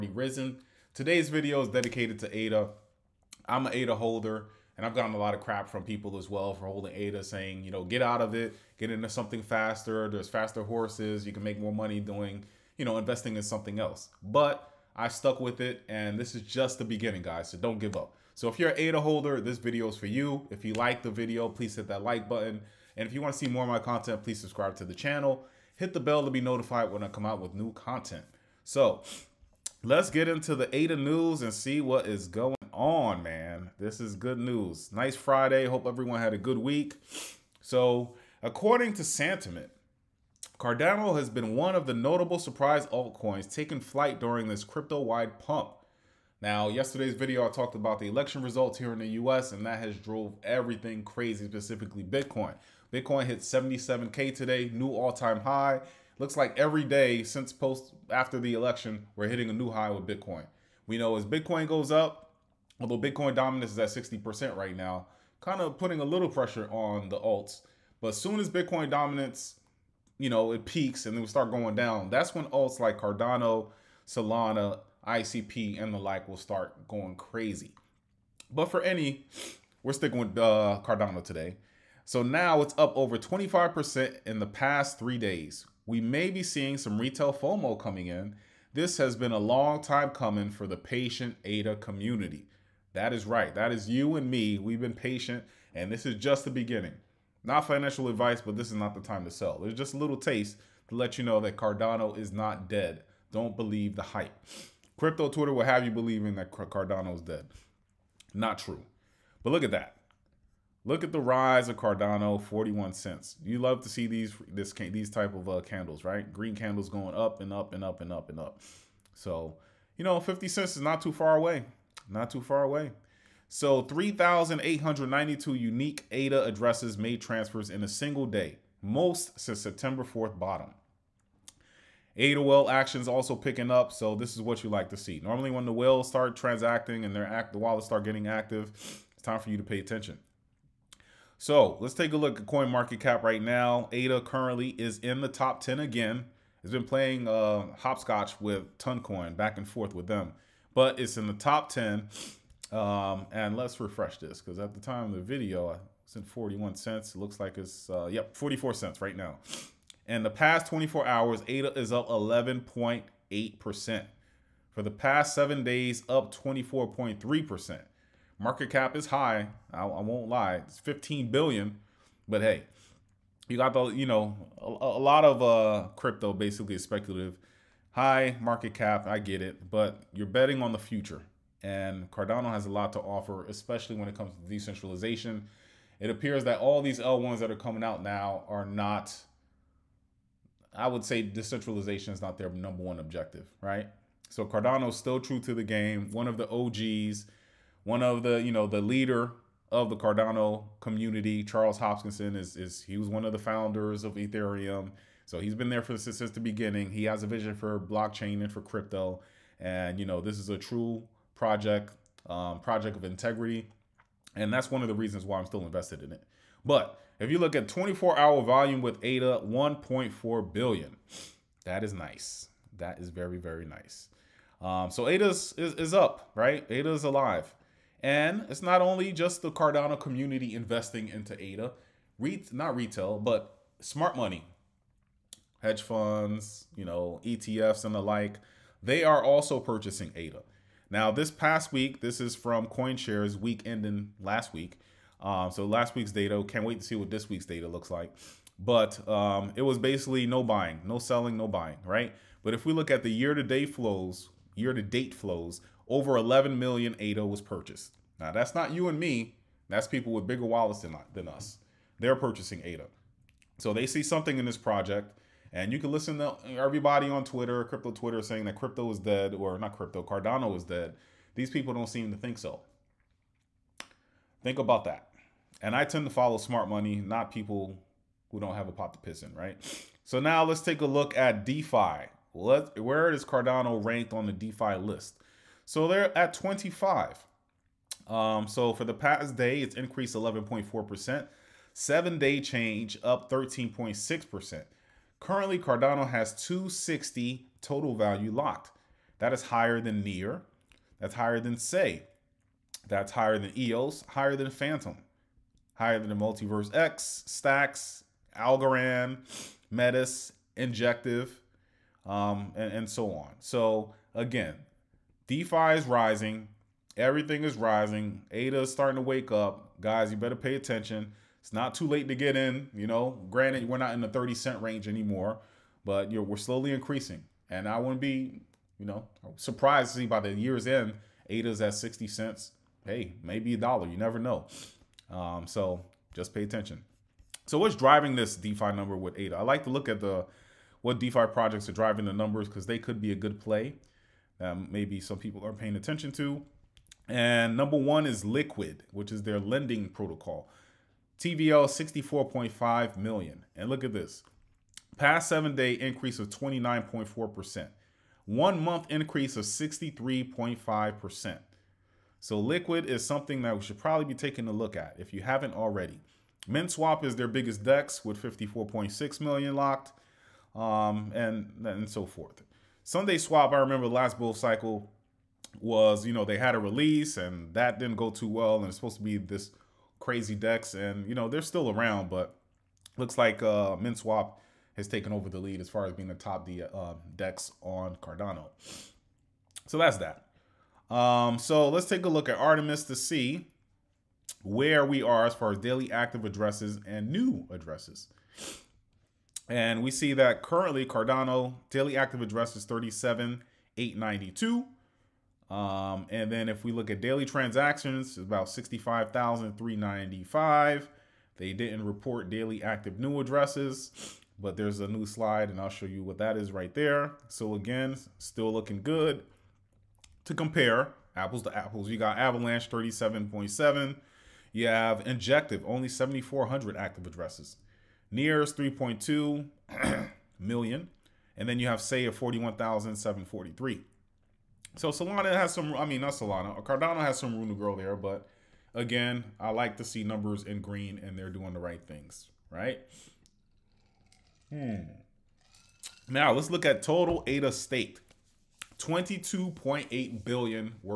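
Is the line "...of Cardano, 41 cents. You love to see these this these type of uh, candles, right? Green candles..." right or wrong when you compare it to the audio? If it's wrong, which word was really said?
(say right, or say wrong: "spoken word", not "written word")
right.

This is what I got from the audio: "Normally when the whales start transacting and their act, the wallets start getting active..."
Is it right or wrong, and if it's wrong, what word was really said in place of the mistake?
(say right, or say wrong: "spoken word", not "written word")
right.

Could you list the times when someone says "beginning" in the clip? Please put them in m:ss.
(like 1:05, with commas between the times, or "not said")
0:16, 1:36, 3:26.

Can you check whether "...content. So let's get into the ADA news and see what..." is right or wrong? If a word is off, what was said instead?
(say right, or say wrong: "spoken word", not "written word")
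right.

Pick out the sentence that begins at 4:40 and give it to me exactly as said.
So now let's take a look at DeFi.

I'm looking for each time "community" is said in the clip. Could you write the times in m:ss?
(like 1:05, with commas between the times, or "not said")
1:31, 3:20, 3:49.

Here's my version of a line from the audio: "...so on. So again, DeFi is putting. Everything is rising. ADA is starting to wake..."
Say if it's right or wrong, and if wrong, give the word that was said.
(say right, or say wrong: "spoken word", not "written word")
wrong: "rising", not "putting".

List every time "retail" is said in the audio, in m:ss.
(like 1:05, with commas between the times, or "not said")
1:26, 3:52.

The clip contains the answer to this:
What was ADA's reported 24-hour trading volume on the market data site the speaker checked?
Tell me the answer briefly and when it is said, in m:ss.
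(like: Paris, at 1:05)
1.4 billion, at 3:39.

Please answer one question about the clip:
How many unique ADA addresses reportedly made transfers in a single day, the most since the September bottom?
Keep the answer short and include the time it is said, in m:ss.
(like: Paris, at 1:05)
3,892, at 2:03.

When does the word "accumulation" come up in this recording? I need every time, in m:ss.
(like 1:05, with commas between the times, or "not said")
not said.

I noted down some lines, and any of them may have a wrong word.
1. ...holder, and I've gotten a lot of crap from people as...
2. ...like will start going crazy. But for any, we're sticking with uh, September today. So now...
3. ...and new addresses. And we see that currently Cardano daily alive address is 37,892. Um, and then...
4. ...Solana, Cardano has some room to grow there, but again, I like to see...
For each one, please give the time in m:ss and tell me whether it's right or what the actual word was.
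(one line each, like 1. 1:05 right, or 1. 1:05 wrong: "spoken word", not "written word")
1. 0:03 right
2. 1:15 wrong: "Cardano", not "September"
3. 6:36 wrong: "active", not "alive"
4. 7:16 right.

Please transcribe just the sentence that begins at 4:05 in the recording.
Um, so last week's data, can't wait to see what this week's data looks like.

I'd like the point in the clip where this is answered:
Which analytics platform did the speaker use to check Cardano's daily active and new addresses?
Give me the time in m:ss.
6:32.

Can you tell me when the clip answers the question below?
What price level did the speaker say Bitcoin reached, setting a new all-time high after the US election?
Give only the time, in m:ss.
0:53.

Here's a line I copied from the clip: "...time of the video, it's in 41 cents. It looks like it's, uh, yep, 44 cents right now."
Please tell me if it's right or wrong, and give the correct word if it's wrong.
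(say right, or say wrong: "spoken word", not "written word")
right.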